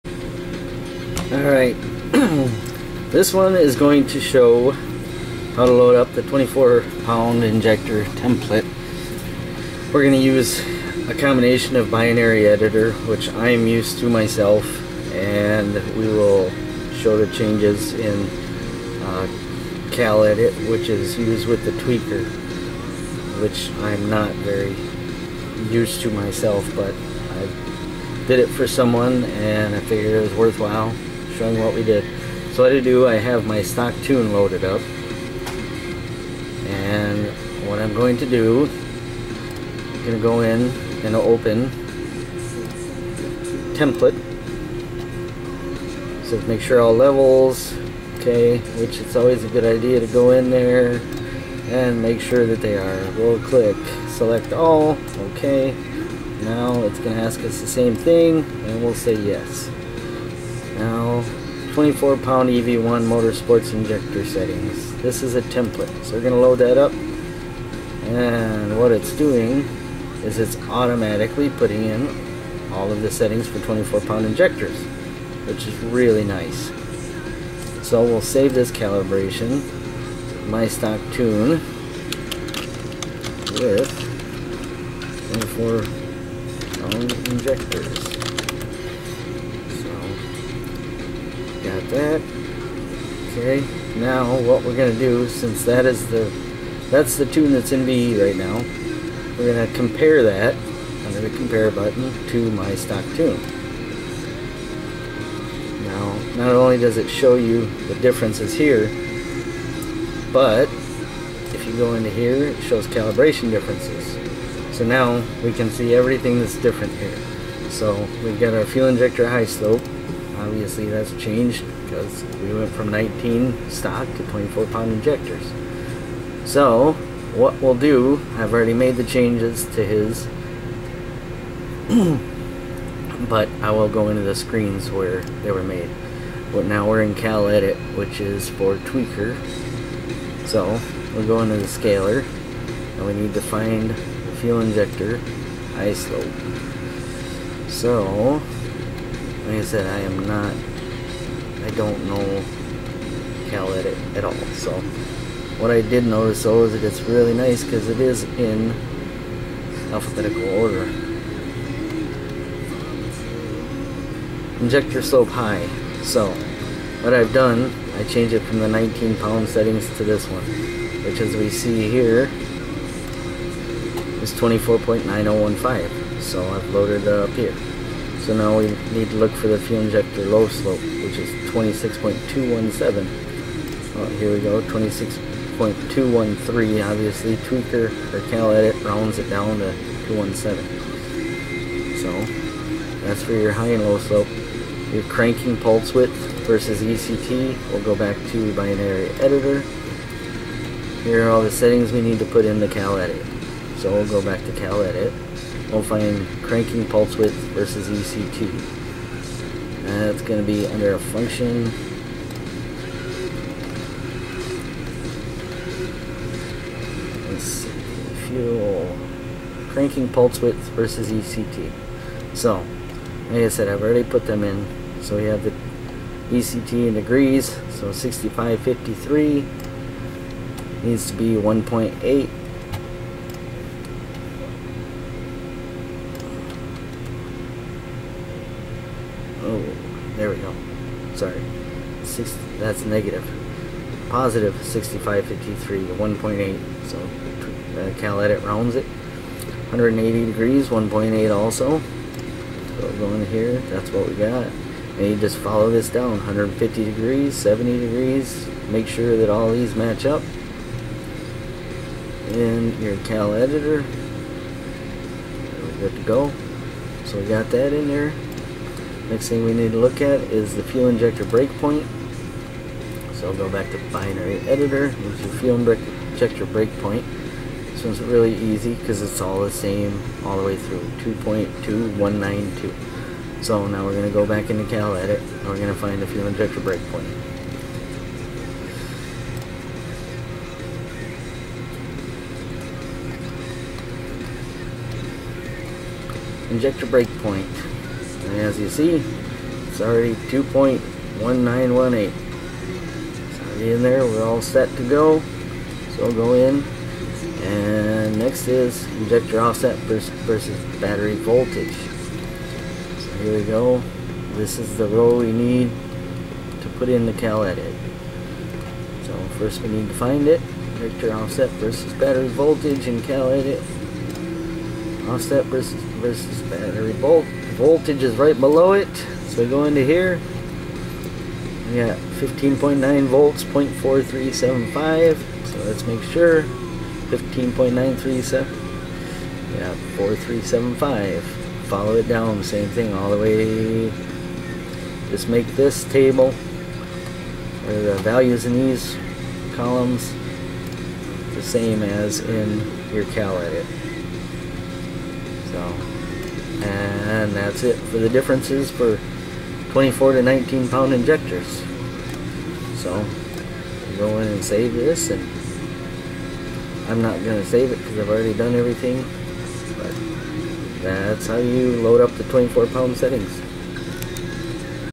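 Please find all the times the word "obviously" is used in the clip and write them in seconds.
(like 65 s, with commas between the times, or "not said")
120 s, 186 s.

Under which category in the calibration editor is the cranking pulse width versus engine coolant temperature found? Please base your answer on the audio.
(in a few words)
function.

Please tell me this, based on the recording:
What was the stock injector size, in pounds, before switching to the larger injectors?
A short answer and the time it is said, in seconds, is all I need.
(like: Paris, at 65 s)
19, at 122 s.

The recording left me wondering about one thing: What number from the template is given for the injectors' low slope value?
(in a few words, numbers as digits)
26.217.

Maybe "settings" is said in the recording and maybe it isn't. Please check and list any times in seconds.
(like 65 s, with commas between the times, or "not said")
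64 s, 73 s, 169 s, 201 s, 372 s.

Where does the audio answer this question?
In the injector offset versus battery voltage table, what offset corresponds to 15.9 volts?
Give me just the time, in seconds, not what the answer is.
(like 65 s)
333 s.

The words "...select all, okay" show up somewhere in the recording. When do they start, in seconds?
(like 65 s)
54 s.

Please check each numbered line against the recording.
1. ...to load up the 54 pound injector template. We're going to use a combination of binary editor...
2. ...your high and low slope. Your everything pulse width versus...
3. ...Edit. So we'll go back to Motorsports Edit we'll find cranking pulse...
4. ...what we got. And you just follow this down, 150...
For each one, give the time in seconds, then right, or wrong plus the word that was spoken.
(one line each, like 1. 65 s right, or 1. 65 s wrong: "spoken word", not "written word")
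1. 5 s wrong: "24", not "54"
2. 193 s wrong: "cranking", not "everything"
3. 202 s wrong: "Cal", not "Motorsports"
4. 253 s right.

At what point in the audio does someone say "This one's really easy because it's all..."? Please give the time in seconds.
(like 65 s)
277 s.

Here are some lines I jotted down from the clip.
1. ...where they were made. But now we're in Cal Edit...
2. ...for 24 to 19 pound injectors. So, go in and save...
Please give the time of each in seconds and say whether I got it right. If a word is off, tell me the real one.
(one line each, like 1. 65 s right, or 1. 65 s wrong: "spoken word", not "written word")
1. 134 s right
2. 358 s right.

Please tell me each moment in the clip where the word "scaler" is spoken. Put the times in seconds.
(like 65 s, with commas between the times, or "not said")
141 s.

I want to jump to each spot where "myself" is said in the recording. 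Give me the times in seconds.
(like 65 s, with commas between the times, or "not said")
14 s, 26 s.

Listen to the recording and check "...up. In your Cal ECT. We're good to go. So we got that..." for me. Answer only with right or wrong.
wrong.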